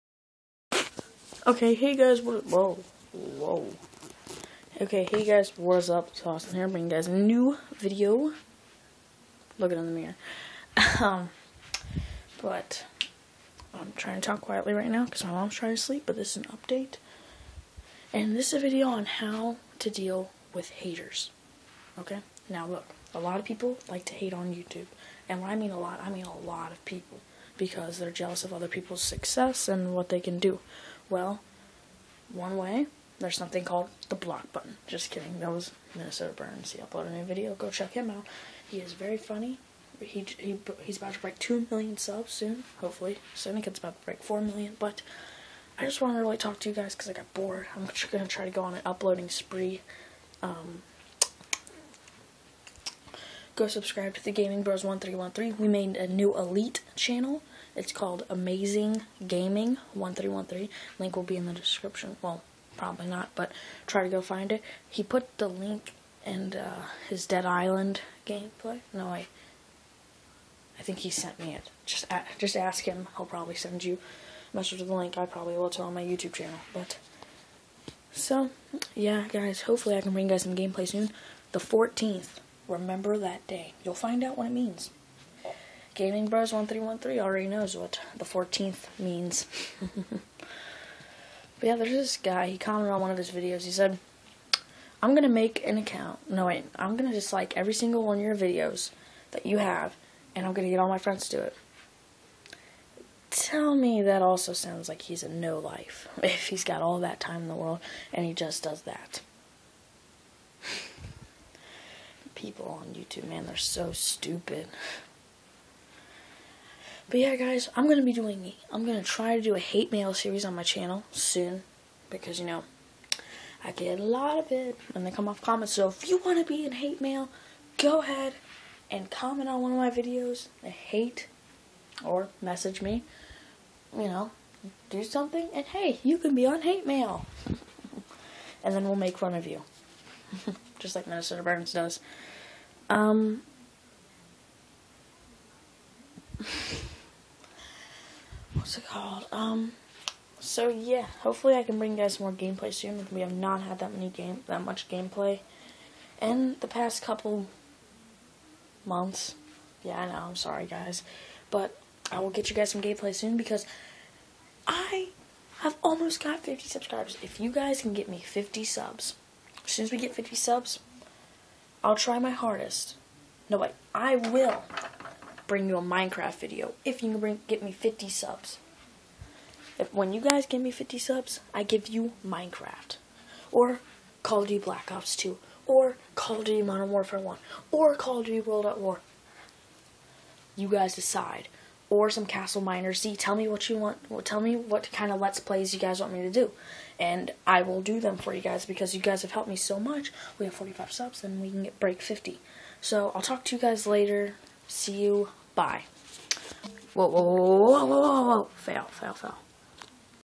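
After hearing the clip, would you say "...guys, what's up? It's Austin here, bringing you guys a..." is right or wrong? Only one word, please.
right.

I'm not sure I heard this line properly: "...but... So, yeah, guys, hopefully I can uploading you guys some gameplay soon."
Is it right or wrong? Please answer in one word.
wrong.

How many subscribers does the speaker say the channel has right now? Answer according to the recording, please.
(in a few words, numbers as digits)
45.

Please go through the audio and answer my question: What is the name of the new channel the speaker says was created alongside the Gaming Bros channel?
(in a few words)
Amazing Gaming 1313.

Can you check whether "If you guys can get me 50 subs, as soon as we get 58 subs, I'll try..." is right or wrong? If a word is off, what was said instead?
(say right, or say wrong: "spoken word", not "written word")
wrong: "50", not "58".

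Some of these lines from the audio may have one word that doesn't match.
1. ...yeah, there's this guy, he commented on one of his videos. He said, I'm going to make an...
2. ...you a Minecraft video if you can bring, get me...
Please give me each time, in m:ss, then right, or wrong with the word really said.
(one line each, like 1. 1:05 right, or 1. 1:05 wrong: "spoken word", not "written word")
1. 1:31 right
2. 2:55 right.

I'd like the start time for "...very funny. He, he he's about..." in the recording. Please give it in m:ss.
0:38.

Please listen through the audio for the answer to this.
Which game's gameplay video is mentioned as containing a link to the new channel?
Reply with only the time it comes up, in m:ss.
1:07.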